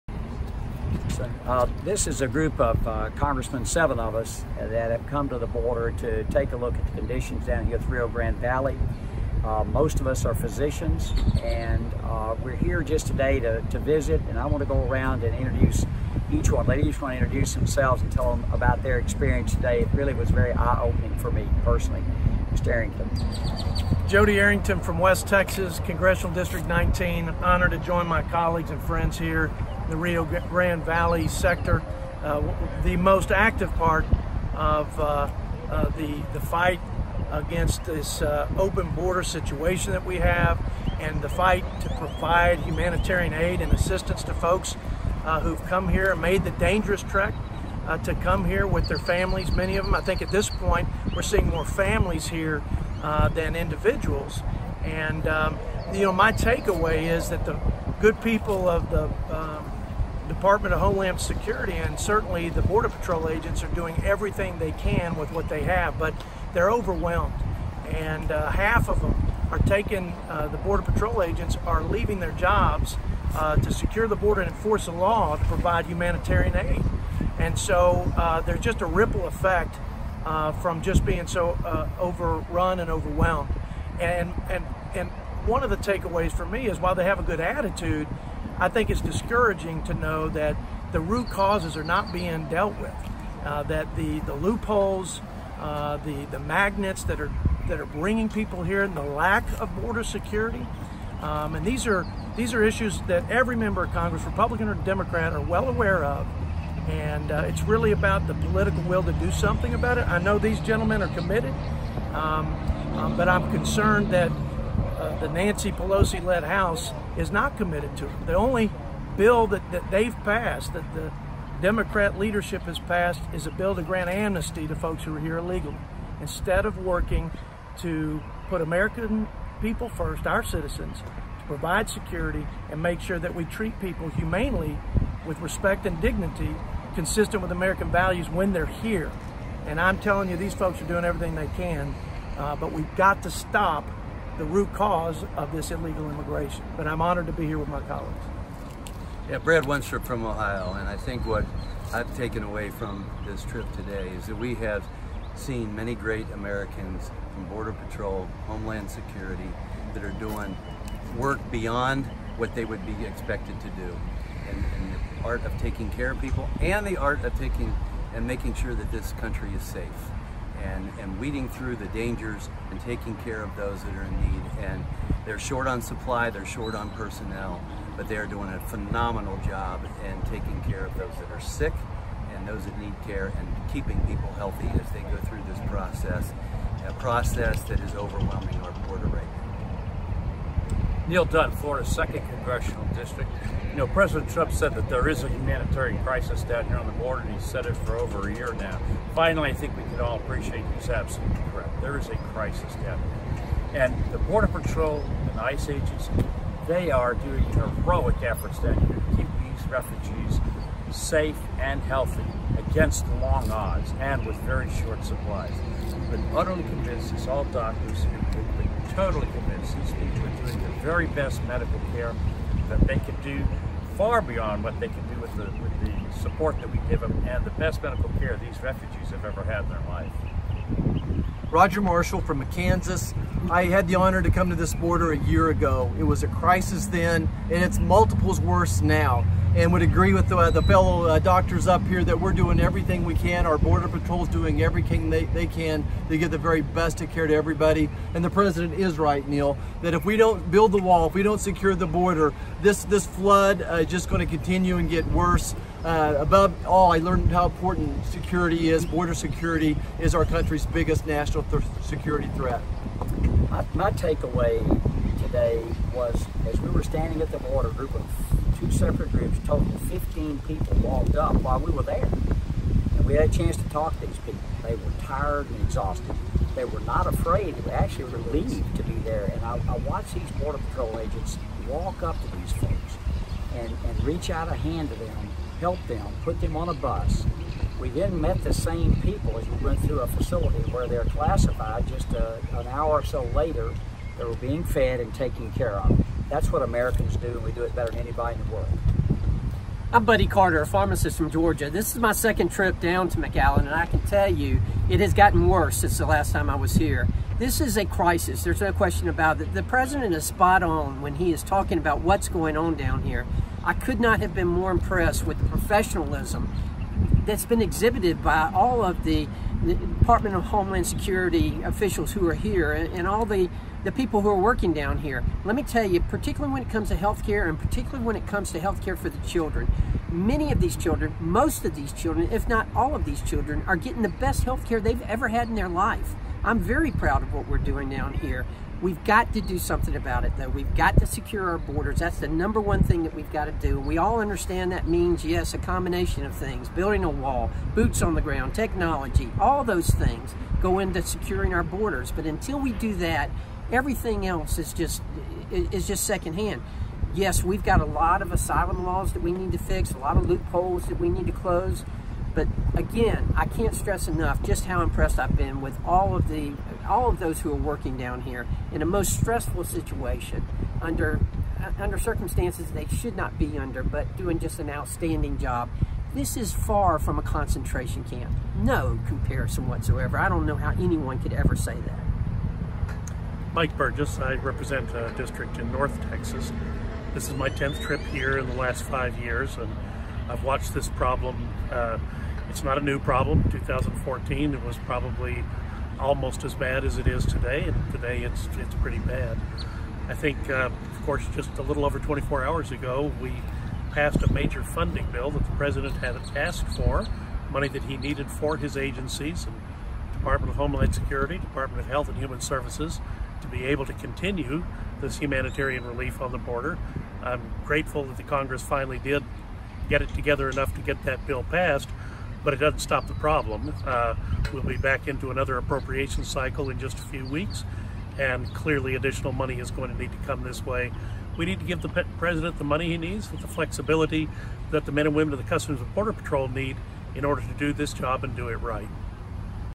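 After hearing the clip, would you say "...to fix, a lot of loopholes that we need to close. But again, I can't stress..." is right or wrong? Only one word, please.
right.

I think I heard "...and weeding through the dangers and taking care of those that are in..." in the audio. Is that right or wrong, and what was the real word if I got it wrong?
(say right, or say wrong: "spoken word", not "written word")
right.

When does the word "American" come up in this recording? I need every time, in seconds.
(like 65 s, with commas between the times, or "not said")
128 s, 137 s, 156 s, 296 s.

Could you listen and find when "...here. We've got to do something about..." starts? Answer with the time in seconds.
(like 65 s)
338 s.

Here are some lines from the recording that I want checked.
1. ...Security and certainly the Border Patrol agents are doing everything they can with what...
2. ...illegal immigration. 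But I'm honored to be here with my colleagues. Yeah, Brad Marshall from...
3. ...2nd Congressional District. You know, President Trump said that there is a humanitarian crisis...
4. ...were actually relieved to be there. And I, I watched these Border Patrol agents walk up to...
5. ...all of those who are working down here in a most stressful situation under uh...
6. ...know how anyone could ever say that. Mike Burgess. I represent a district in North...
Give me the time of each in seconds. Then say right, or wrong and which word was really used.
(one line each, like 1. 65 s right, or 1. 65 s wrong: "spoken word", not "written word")
1. 61 s right
2. 145 s wrong: "Wenstrup", not "Marshall"
3. 191 s right
4. 277 s right
5. 366 s right
6. 380 s right.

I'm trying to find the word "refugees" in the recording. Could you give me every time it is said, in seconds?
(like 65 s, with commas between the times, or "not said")
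209 s, 228 s.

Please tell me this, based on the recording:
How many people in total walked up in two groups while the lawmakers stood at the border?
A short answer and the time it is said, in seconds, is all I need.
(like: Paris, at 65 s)
15, at 269 s.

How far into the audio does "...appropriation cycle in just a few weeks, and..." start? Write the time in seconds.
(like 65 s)
425 s.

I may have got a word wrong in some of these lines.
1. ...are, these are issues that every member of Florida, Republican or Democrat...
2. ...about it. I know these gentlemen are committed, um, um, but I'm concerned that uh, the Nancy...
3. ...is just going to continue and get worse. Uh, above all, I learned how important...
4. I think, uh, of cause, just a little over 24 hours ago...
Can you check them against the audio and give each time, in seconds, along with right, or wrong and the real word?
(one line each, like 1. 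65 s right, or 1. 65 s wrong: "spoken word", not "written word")
1. 101 s wrong: "Congress", not "Florida"
2. 109 s right
3. 253 s right
4. 400 s wrong: "course", not "cause".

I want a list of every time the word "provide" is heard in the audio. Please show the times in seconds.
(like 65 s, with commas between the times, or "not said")
41 s, 75 s, 131 s.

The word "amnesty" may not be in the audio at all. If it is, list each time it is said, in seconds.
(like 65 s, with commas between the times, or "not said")
124 s.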